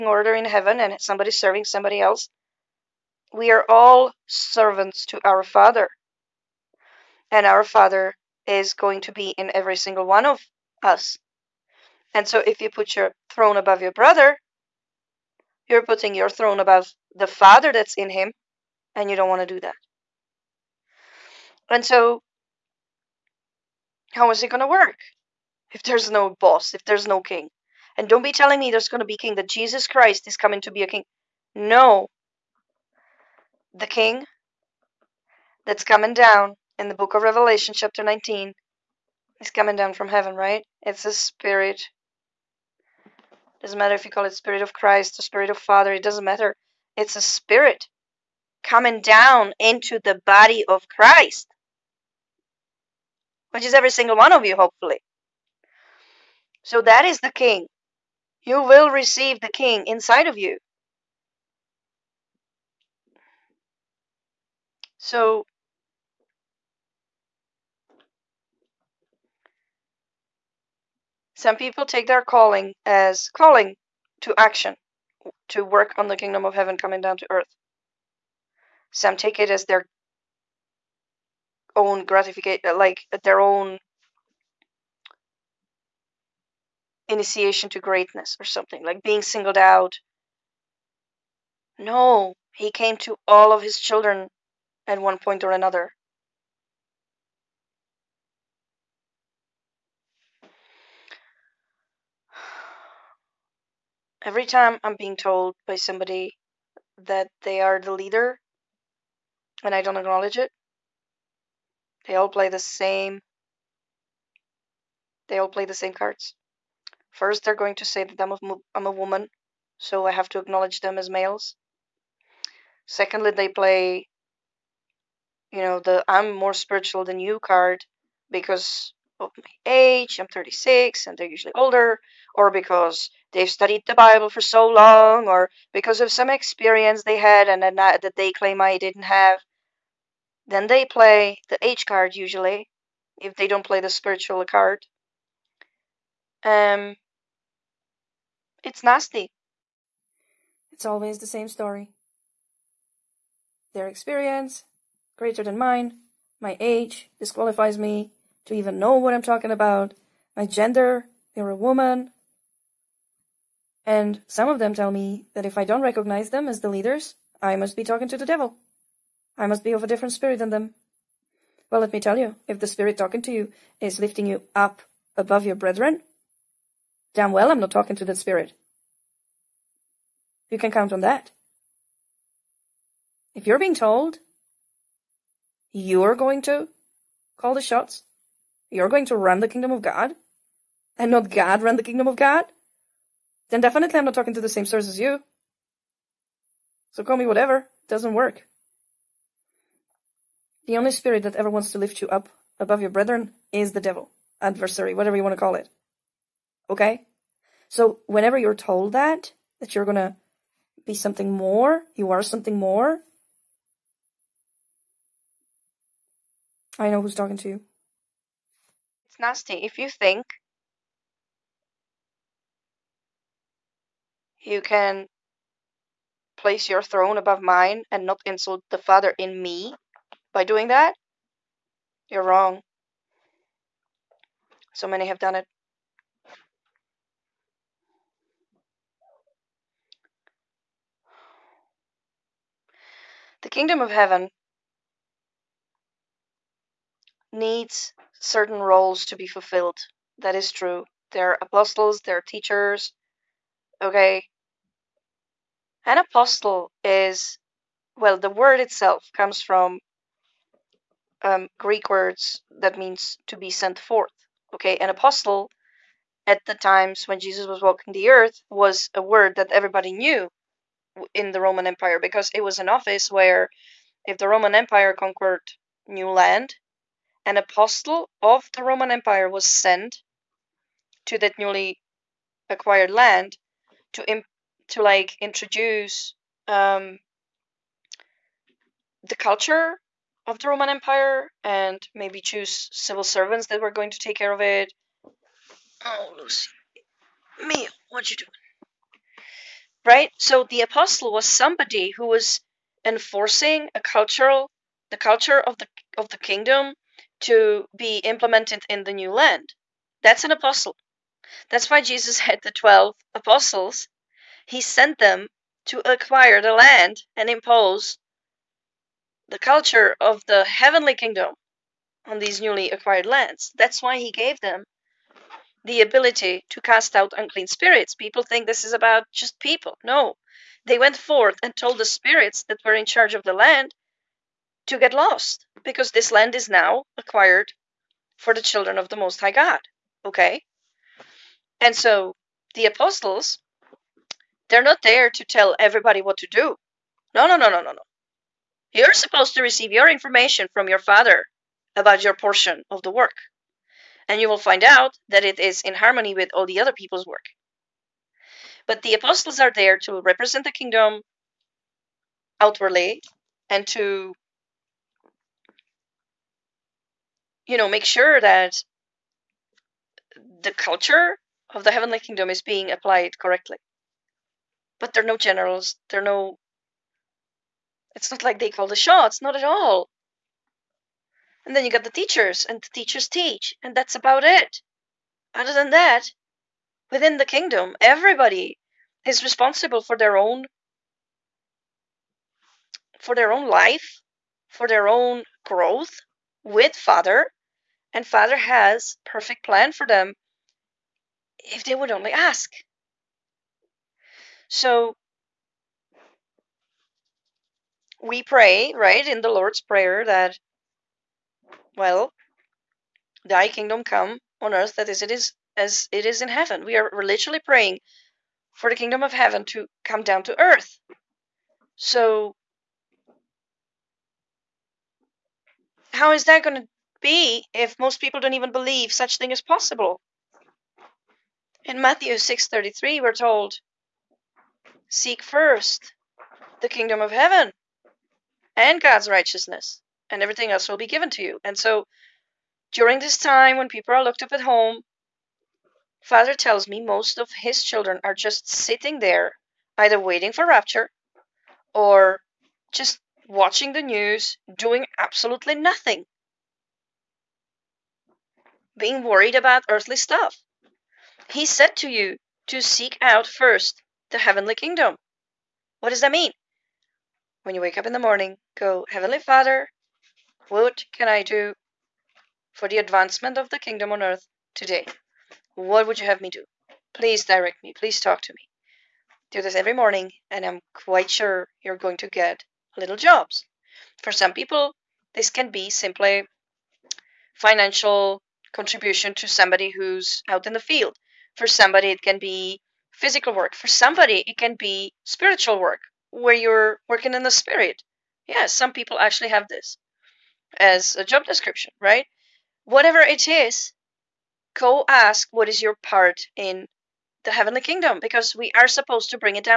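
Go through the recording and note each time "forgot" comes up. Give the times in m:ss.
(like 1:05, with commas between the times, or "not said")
not said.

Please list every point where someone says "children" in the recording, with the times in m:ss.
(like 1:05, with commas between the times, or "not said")
1:33, 5:38, 7:27.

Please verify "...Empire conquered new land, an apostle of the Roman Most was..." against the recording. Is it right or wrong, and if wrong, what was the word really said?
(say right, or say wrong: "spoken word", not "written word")
wrong: "Empire", not "Most".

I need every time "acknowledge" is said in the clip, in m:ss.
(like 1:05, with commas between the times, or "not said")
1:49, 2:00.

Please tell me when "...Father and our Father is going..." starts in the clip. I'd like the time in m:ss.
0:05.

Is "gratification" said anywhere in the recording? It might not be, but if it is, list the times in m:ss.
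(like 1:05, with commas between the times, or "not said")
1:22.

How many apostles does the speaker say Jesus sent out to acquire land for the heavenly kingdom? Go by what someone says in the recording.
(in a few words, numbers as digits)
12.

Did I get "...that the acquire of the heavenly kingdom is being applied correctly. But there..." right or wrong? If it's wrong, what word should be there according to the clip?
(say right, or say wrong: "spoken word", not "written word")
wrong: "culture", not "acquire".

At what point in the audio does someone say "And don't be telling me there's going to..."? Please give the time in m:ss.
0:27.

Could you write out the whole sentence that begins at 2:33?
Their experience, greater than mine, my age, disqualifies me, to even know what I'm talking about, my gender, they're a woman.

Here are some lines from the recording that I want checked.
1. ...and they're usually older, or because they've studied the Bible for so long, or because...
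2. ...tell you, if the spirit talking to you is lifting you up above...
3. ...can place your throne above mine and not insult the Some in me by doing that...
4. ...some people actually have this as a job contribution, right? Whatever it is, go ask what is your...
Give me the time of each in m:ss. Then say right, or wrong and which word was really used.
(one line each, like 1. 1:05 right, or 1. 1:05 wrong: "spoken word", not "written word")
1. 2:11 right
2. 2:51 right
3. 3:44 wrong: "Father", not "Some"
4. 8:18 wrong: "description", not "contribution".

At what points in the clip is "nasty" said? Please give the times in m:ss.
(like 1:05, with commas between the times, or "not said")
2:28, 3:39.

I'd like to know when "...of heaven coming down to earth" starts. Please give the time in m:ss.
1:16.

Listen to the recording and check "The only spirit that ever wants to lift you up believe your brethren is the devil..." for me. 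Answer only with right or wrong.
wrong.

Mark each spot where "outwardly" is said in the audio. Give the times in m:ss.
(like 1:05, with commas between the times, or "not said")
6:02.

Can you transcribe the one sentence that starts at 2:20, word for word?
Then they play the age card usually, if they don't play the spiritual card.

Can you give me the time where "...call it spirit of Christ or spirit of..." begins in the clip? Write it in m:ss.
0:44.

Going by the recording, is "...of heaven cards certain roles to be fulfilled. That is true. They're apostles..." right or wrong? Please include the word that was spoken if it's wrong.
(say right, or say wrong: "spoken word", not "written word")
wrong: "needs", not "cards".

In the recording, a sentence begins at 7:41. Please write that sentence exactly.
He said to you to seek out first the heavenly kingdom.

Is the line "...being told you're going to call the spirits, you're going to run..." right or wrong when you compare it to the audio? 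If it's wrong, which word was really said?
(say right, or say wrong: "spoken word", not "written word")
wrong: "shots", not "spirits".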